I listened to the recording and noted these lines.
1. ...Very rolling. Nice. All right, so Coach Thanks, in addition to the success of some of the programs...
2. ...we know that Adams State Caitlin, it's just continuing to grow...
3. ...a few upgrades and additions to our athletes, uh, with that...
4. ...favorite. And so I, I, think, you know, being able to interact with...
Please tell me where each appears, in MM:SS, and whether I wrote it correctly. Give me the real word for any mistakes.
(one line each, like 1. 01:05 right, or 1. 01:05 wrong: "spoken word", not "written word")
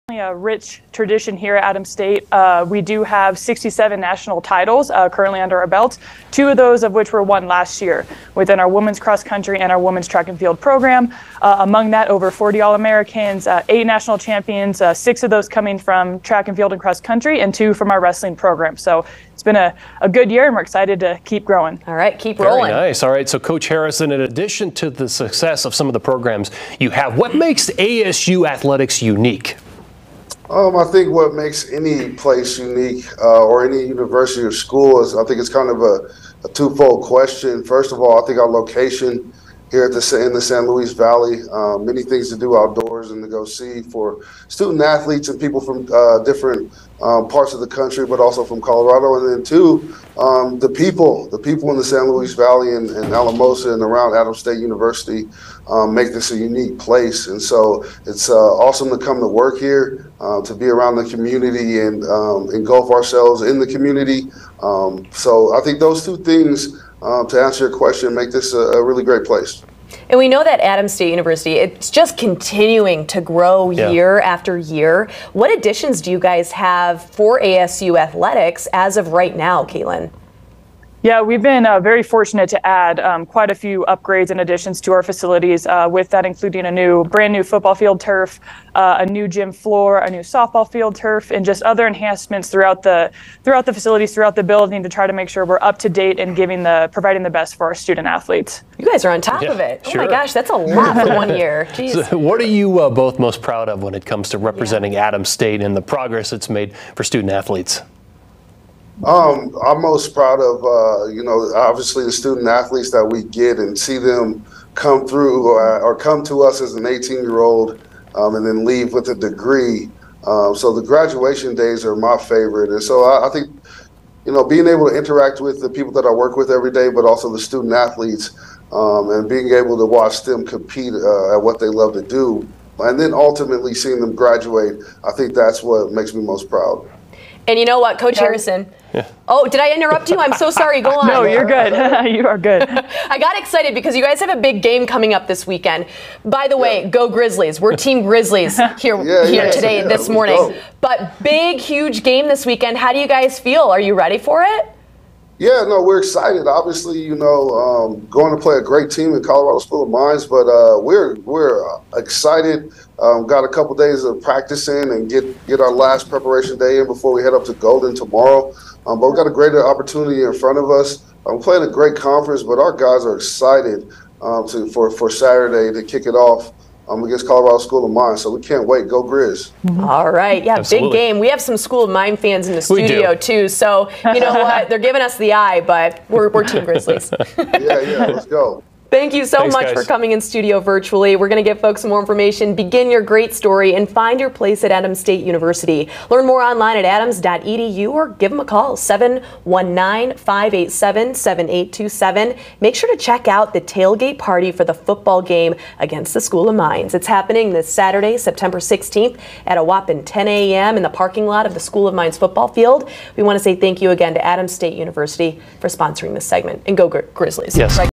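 1. 00:22 wrong: "Harrison", not "Thanks"
2. 01:10 wrong: "University", not "Caitlin"
3. 01:23 wrong: "facilities", not "athletes"
4. 02:02 right.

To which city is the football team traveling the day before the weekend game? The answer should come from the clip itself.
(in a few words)
Golden.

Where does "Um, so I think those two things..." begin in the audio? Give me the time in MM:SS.
01:04.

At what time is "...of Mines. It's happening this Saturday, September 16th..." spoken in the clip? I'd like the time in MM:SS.
03:26.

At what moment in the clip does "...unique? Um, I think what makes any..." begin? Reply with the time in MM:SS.
00:29.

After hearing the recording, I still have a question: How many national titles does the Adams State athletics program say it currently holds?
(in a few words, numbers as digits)
67.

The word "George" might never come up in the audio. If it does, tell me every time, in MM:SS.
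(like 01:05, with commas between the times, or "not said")
not said.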